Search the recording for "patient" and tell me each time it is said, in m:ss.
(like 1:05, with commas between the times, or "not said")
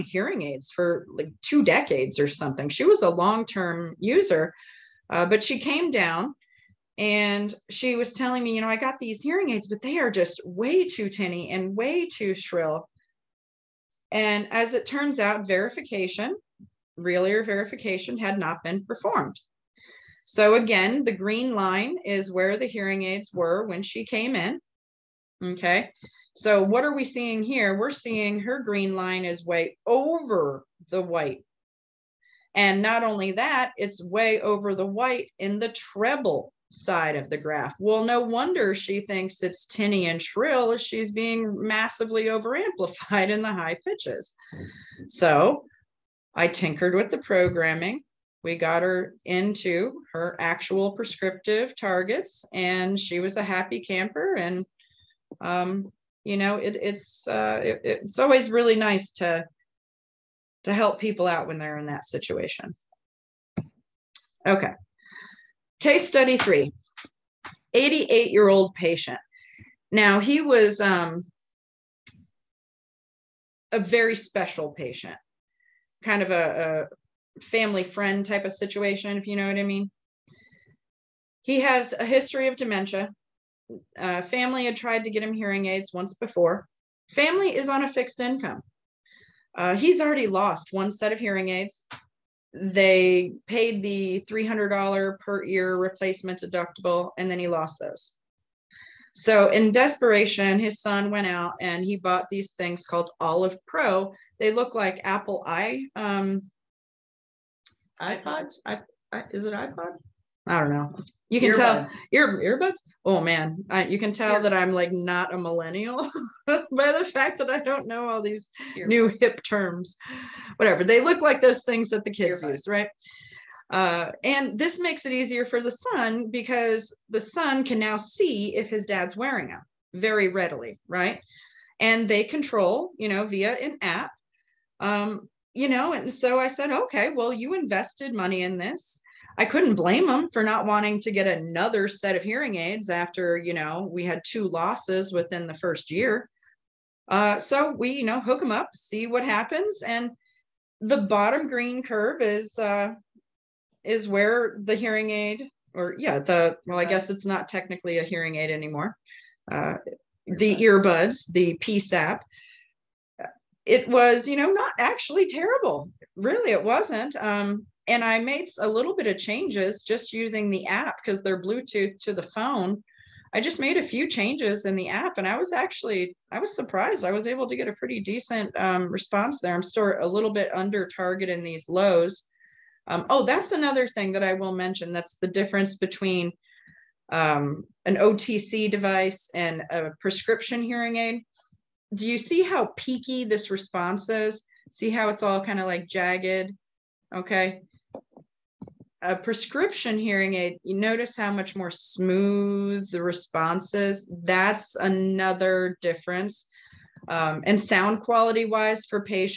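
1:08, 1:14.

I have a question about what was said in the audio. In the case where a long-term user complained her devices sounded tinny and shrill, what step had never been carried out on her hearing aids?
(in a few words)
Real ear verification.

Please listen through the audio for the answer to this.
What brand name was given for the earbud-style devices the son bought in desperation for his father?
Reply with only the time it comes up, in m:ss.
1:43.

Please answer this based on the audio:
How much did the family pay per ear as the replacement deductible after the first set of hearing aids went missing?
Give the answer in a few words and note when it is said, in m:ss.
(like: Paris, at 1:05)
$300, at 1:34.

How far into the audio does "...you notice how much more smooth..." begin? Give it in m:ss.
3:20.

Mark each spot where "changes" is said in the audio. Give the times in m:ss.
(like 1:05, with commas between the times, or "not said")
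2:49, 2:54.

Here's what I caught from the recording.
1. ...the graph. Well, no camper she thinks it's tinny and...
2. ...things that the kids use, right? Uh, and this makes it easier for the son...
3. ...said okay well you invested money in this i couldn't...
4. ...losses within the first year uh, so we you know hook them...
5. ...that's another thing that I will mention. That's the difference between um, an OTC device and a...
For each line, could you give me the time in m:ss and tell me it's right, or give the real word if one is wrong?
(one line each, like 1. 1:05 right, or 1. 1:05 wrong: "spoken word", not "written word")
1. 0:37 wrong: "wonder", not "camper"
2. 2:01 right
3. 2:16 right
4. 2:24 right
5. 3:03 right.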